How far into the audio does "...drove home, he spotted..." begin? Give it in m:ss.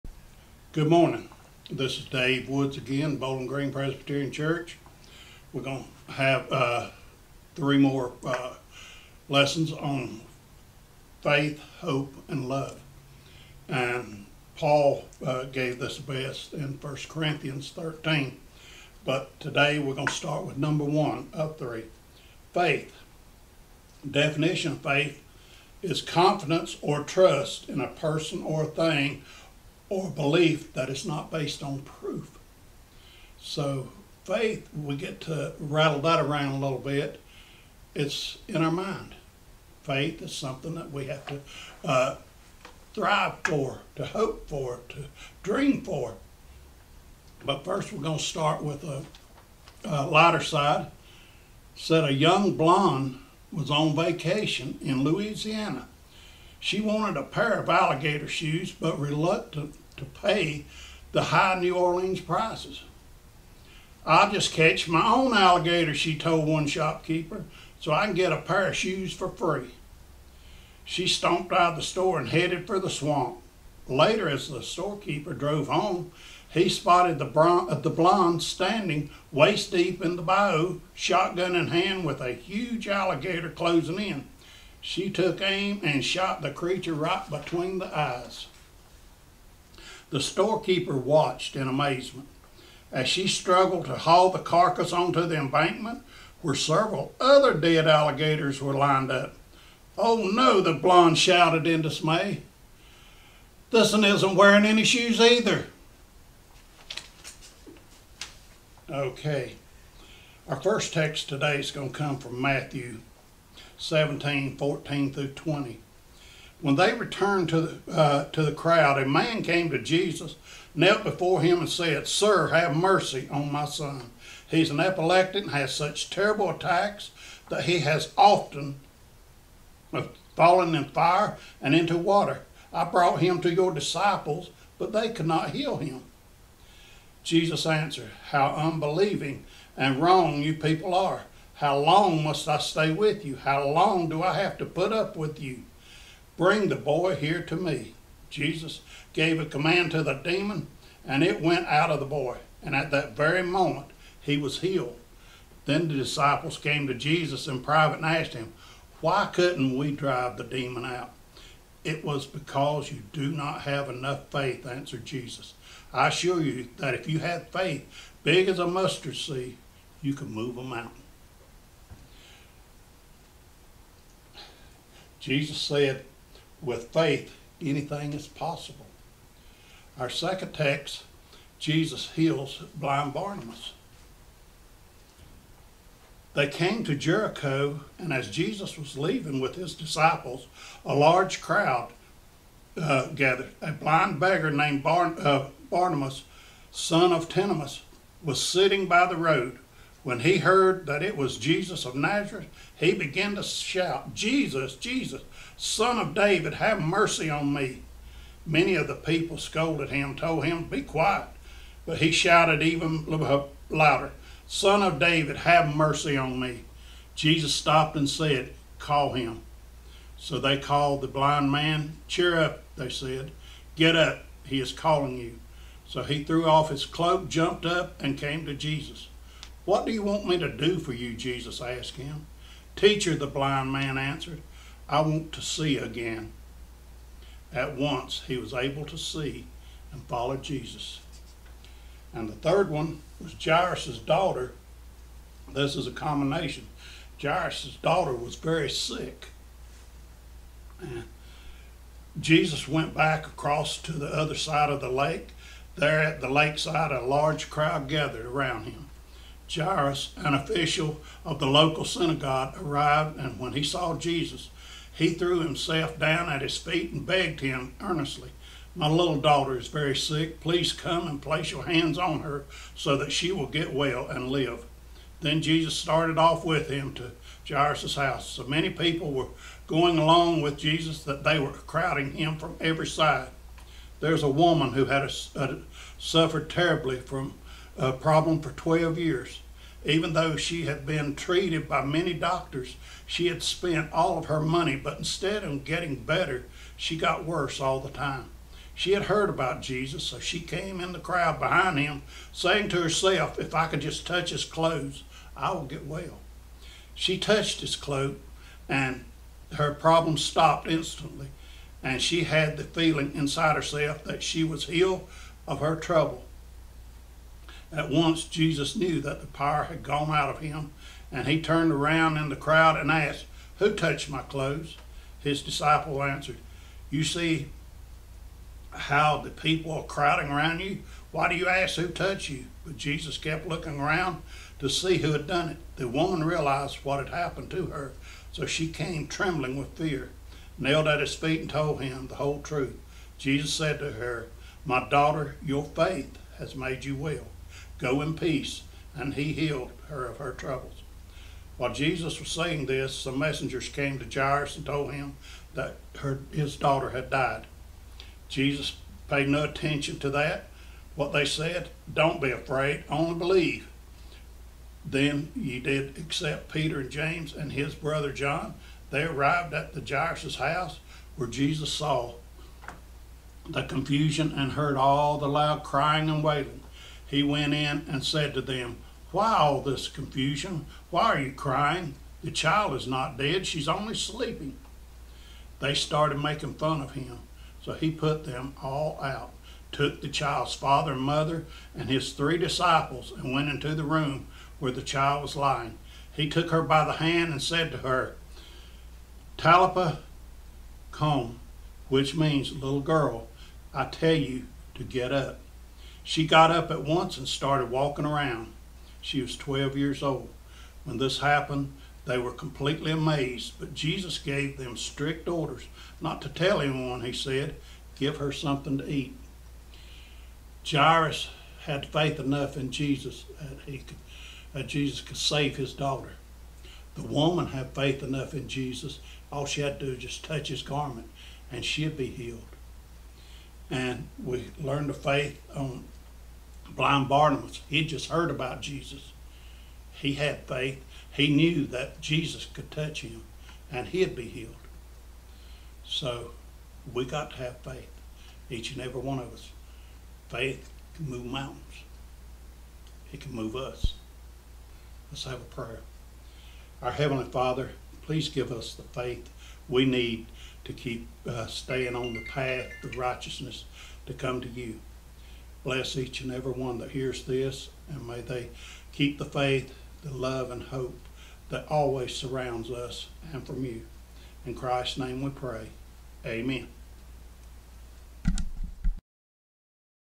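1:15.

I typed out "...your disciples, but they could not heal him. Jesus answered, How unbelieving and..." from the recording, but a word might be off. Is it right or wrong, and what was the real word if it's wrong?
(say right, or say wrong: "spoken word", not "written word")
right.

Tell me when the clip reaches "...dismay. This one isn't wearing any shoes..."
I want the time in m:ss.
1:41.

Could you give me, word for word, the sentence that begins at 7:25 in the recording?
So we got to have faith, each and every one of us.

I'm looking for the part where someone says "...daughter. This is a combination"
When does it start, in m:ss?
4:03.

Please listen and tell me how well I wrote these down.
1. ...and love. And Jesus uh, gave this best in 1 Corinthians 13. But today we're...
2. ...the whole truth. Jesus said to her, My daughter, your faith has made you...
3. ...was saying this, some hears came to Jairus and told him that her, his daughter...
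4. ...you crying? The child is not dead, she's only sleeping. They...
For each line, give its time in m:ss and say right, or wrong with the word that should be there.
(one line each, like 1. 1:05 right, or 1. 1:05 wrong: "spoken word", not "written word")
1. 0:12 wrong: "Paul", not "Jesus"
2. 5:42 right
3. 5:52 wrong: "messengers", not "hears"
4. 6:21 right.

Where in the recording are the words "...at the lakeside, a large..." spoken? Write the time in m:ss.
4:16.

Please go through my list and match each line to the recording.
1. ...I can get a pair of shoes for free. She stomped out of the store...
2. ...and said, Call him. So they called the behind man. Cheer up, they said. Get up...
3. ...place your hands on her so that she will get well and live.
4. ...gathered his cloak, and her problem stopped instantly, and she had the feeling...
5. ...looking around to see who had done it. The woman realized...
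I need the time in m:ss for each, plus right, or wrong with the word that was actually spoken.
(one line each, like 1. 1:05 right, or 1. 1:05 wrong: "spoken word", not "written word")
1. 1:07 right
2. 3:37 wrong: "blind", not "behind"
3. 4:31 right
4. 5:07 wrong: "touched", not "gathered"
5. 5:33 right.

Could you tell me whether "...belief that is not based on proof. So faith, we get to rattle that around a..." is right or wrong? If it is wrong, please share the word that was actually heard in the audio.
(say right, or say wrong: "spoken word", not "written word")
right.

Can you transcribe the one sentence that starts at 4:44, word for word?
There's a woman who had a, a, suffered terribly from a problem for 12 years.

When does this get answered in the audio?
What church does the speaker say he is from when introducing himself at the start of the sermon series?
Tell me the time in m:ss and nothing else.
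0:03.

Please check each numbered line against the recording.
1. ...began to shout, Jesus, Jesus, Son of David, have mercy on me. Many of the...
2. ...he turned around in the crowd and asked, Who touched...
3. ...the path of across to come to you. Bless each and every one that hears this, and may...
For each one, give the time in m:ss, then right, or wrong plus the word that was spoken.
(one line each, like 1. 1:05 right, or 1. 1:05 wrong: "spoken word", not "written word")
1. 3:22 right
2. 5:21 right
3. 7:42 wrong: "righteousness", not "across".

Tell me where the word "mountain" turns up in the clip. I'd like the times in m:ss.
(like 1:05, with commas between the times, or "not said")
2:50, 7:31.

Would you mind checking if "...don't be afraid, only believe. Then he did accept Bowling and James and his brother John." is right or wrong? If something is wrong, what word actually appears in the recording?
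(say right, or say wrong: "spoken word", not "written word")
wrong: "Peter", not "Bowling".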